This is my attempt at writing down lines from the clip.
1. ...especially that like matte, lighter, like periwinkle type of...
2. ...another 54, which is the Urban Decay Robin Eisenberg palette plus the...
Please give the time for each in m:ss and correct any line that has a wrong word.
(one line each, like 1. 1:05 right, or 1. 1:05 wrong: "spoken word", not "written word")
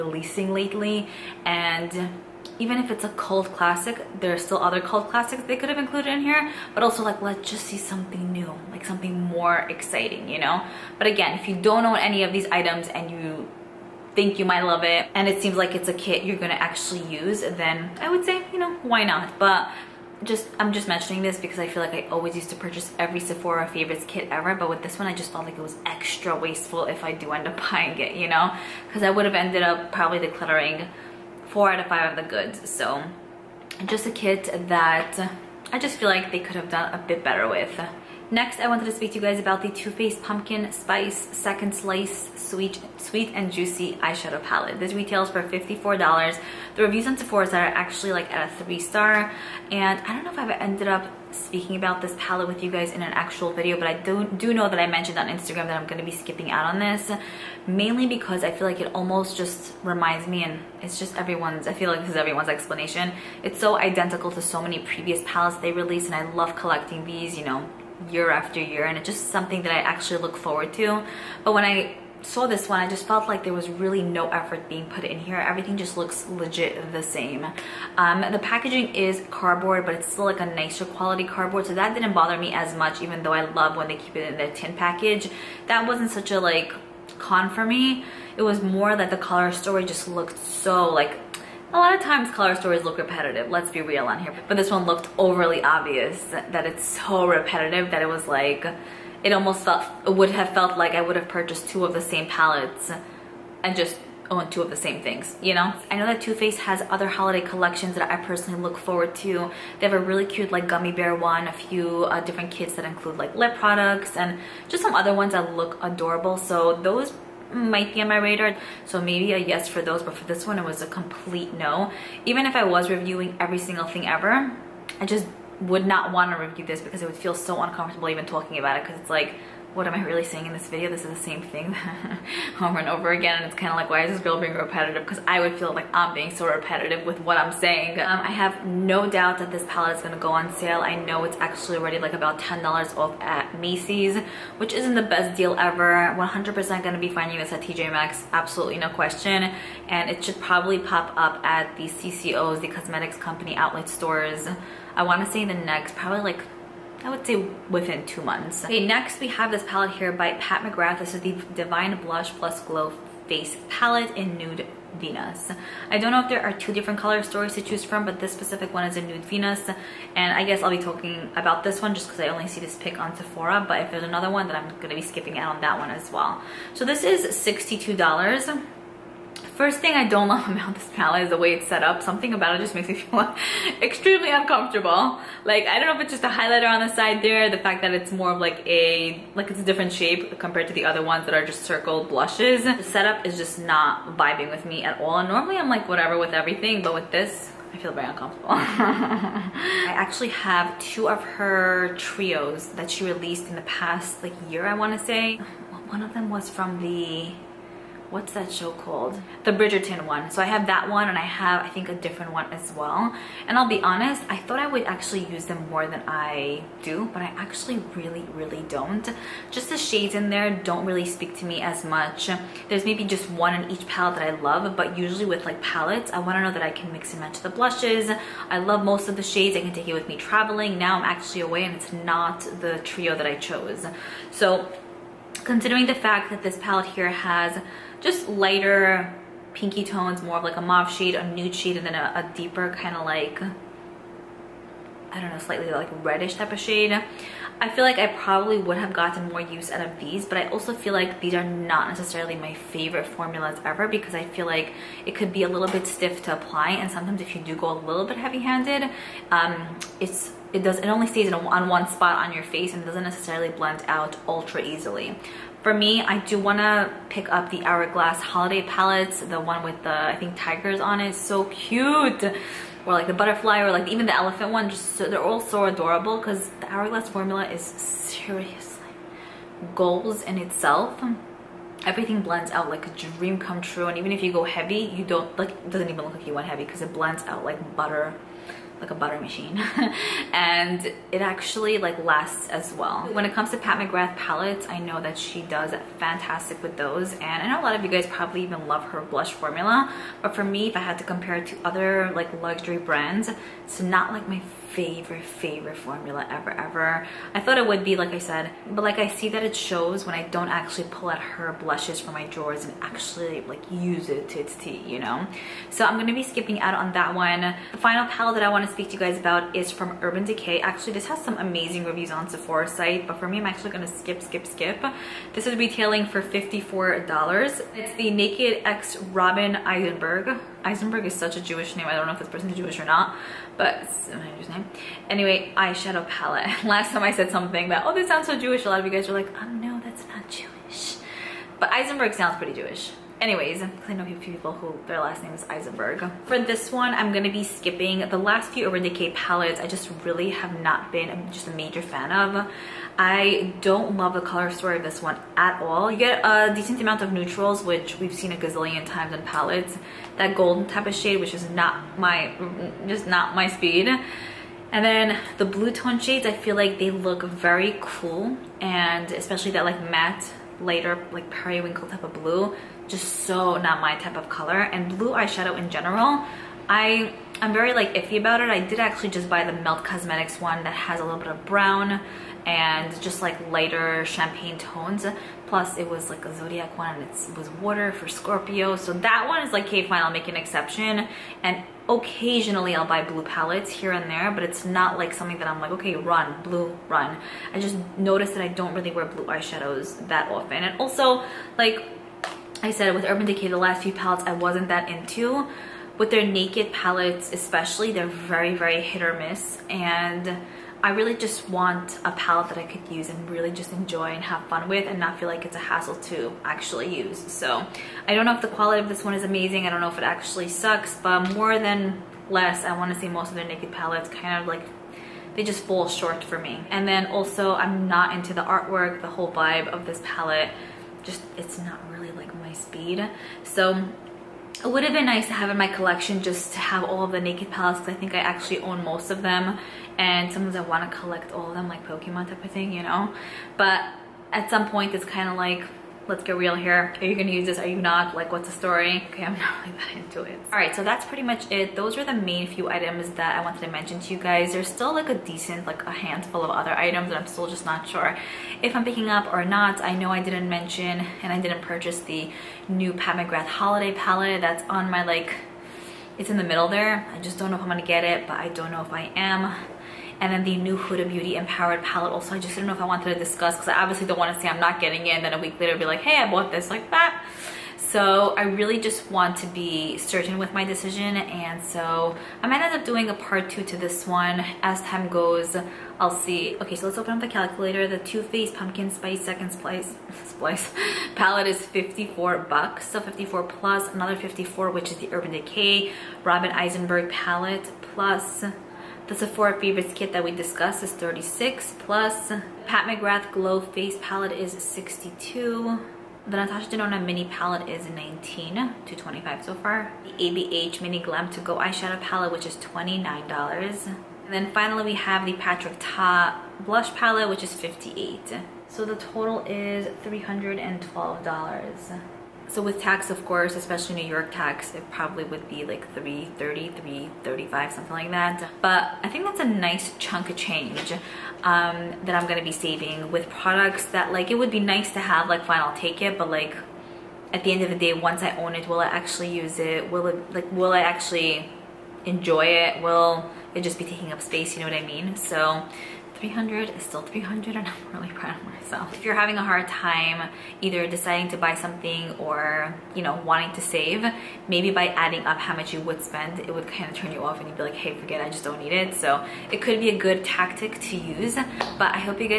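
1. 6:09 right
2. 8:13 right.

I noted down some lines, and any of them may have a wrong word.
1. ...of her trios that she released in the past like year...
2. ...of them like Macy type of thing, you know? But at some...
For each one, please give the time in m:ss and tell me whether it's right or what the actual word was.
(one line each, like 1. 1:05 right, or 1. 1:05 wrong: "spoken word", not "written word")
1. 3:21 right
2. 7:21 wrong: "Pokemon", not "Macy".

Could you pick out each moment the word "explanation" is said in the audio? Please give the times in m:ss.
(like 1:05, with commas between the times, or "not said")
1:02.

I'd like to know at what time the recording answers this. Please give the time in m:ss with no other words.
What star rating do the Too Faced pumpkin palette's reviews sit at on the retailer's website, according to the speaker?
0:48.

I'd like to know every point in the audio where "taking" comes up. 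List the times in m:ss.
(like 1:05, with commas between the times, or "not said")
9:03.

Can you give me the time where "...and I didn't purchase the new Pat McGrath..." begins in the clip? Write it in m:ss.
7:41.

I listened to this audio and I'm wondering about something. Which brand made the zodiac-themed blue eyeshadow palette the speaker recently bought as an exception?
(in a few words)
Melt Cosmetics.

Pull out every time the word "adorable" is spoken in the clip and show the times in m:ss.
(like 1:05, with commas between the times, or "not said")
1:55, 4:35.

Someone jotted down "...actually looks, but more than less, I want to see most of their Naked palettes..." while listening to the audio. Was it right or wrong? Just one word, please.
wrong.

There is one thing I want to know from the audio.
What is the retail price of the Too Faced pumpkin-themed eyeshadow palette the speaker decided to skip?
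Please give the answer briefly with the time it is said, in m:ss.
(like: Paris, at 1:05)
$54, at 0:44.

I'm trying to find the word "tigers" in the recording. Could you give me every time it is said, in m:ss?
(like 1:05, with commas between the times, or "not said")
4:30.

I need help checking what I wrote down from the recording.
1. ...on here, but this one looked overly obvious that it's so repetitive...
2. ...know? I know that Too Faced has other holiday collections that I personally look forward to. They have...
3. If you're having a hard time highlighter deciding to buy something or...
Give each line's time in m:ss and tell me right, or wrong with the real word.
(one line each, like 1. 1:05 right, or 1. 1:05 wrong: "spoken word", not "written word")
1. 1:34 right
2. 1:45 right
3. 9:08 wrong: "either", not "highlighter".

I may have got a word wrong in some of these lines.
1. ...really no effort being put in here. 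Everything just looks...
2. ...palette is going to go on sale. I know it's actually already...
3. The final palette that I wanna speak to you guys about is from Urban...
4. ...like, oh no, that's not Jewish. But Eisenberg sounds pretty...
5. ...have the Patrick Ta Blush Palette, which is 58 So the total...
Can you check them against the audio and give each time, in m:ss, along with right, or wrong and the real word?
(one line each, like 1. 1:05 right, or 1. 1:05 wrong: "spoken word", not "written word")
1. 1:13 right
2. 2:19 right
3. 5:17 right
4. 5:39 right
5. 8:34 right.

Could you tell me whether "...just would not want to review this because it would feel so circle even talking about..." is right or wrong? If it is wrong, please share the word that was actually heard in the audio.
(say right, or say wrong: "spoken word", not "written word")
wrong: "uncomfortable", not "circle".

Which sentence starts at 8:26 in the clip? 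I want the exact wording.
The Natasha Denona Mini Palette is 19 to 25 so far.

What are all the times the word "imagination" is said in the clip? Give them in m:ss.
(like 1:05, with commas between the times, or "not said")
not said.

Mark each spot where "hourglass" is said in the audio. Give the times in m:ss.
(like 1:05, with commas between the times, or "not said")
4:27, 4:36.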